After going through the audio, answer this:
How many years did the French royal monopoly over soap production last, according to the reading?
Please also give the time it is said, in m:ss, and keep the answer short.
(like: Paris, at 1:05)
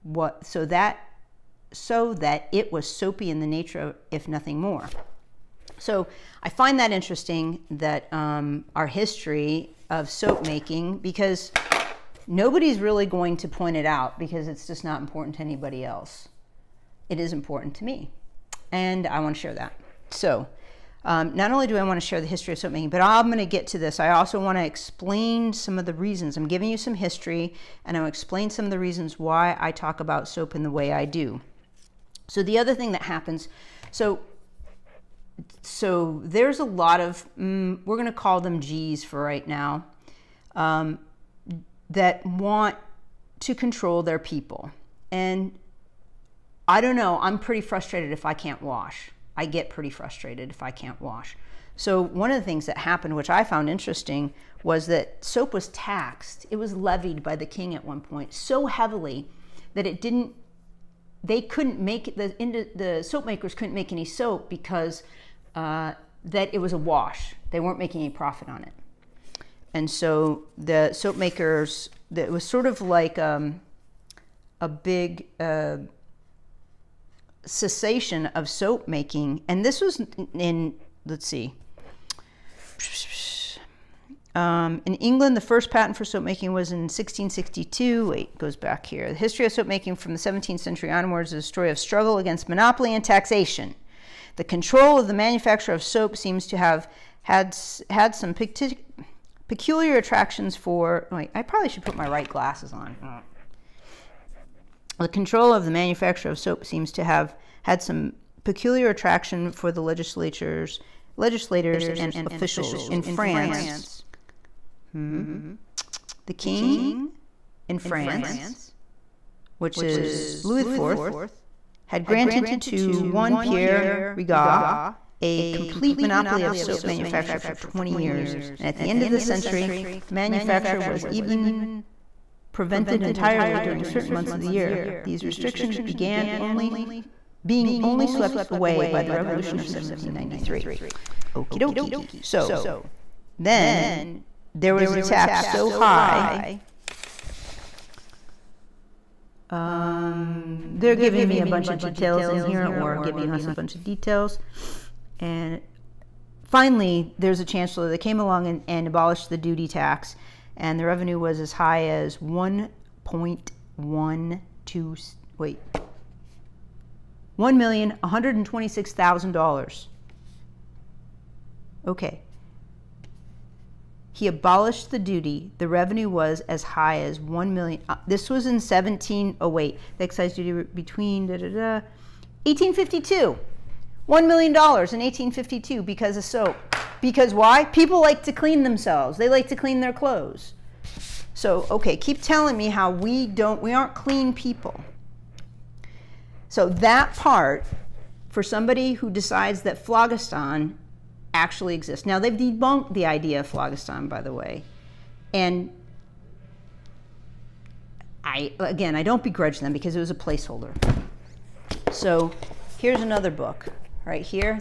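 20 years, at 2:07.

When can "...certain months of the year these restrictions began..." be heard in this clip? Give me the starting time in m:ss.
2:13.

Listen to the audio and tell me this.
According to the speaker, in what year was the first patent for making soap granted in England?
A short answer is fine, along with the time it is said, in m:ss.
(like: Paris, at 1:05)
1662, at 1:26.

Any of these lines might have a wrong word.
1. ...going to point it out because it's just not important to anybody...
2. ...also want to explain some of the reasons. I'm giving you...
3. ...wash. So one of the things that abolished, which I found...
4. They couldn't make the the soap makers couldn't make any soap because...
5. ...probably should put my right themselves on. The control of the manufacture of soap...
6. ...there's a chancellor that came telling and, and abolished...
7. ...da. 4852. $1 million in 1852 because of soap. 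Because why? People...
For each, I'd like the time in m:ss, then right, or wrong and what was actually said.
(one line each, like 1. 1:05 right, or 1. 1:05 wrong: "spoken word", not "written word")
1. 0:13 right
2. 0:24 right
3. 0:51 wrong: "happened", not "abolished"
4. 1:01 right
5. 1:41 wrong: "glasses", not "themselves"
6. 2:37 wrong: "along", not "telling"
7. 3:01 wrong: "1852", not "4852".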